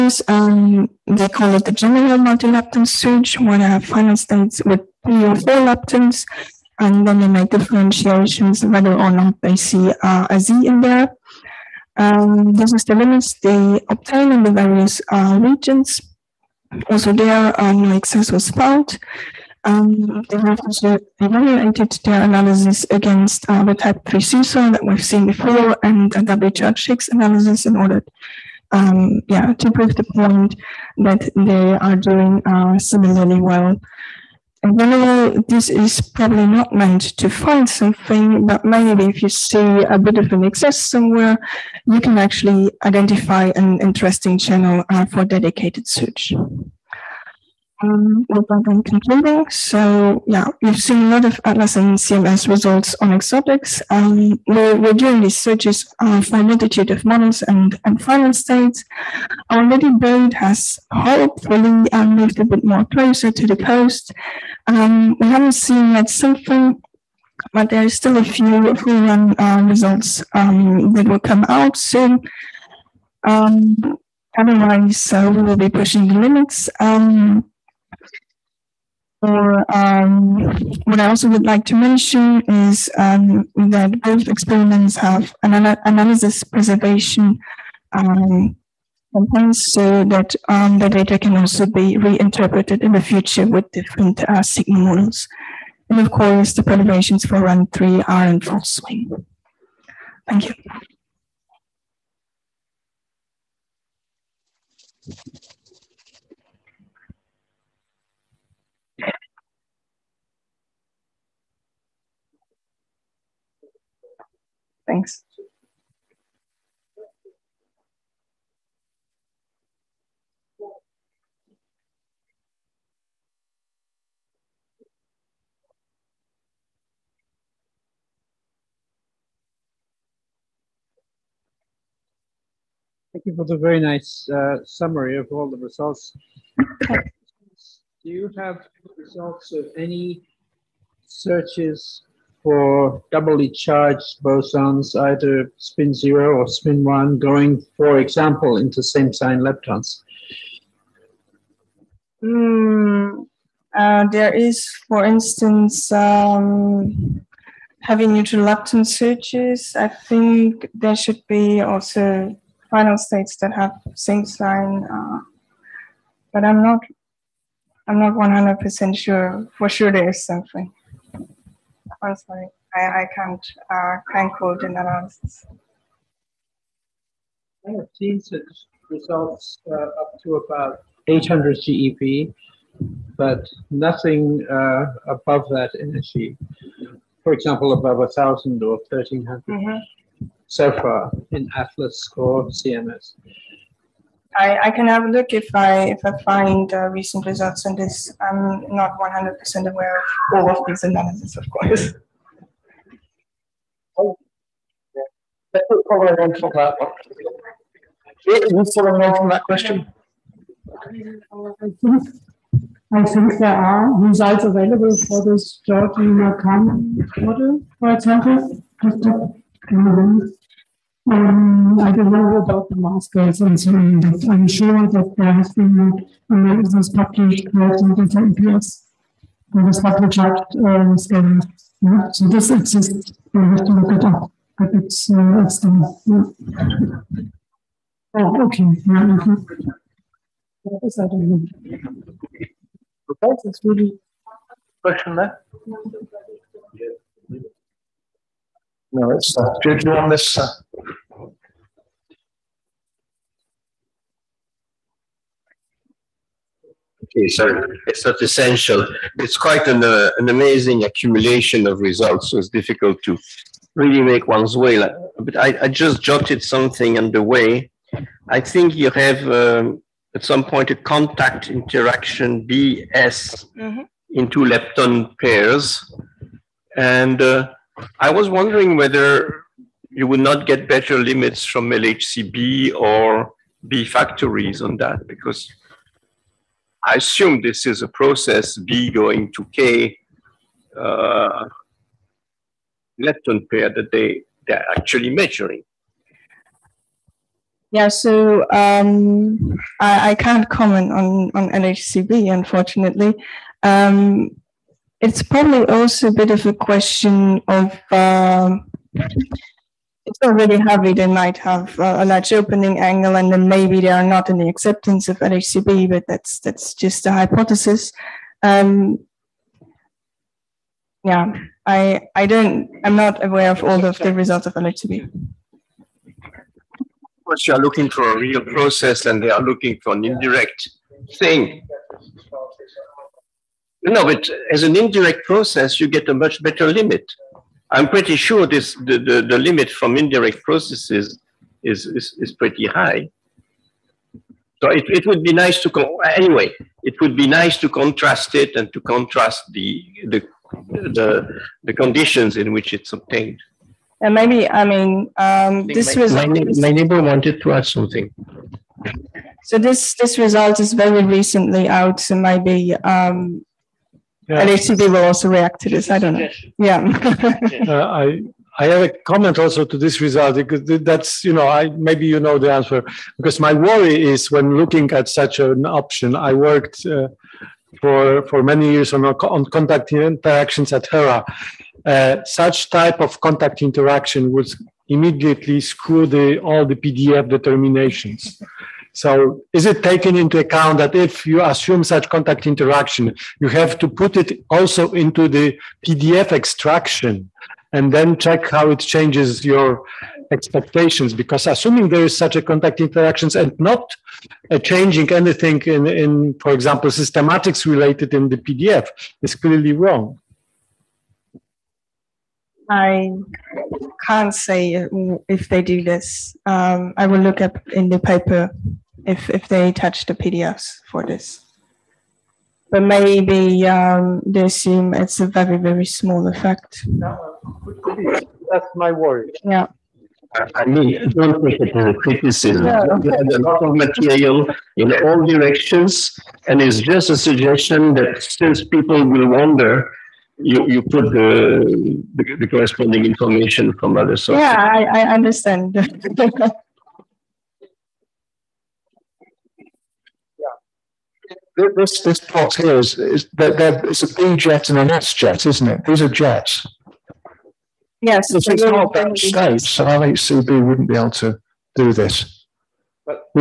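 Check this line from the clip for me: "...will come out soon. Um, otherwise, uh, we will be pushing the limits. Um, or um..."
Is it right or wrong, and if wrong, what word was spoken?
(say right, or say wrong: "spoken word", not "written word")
right.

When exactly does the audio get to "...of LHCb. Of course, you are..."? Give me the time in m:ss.
5:24.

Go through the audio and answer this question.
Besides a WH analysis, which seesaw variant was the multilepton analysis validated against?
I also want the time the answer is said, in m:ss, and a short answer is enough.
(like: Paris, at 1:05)
type 3 seesaw, at 0:23.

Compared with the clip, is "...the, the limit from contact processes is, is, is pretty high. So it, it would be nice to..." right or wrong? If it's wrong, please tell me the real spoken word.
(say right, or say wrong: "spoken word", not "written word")
wrong: "indirect", not "contact".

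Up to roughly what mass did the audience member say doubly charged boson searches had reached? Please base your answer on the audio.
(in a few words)
800 GeV.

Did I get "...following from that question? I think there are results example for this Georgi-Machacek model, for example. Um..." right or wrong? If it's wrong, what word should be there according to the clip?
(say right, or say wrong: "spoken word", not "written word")
wrong: "available", not "example".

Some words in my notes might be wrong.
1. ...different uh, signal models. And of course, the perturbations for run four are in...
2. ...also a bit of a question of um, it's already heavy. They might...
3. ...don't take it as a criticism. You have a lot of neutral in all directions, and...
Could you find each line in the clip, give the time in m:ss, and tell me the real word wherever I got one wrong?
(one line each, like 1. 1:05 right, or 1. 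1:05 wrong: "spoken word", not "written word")
1. 1:33 wrong: "three", not "four"
2. 5:05 right
3. 7:11 wrong: "material", not "neutral".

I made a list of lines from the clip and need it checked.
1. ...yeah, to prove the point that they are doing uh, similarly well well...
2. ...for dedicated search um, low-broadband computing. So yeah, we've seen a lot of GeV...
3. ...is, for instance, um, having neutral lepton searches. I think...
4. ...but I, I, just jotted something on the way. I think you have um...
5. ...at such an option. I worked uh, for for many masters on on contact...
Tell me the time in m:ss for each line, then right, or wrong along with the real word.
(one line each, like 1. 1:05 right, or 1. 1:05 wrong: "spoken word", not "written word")
1. 0:29 right
2. 0:45 wrong: "Atlas", not "GeV"
3. 2:34 right
4. 4:25 right
5. 6:14 wrong: "years", not "masters".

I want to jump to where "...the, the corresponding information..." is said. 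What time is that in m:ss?
7:22.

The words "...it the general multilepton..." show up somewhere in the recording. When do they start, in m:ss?
0:01.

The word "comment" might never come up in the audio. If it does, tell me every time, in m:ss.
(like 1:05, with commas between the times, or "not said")
5:00, 6:09.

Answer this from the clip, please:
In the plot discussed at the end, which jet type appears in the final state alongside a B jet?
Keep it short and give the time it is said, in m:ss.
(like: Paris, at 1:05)
S jet, at 7:34.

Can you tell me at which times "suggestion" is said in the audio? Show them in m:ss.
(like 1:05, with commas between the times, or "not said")
7:17.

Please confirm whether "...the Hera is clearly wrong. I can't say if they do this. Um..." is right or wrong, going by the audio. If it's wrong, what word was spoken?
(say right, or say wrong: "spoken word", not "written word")
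wrong: "PDF", not "Hera".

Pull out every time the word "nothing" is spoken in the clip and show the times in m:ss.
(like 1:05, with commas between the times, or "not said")
3:03.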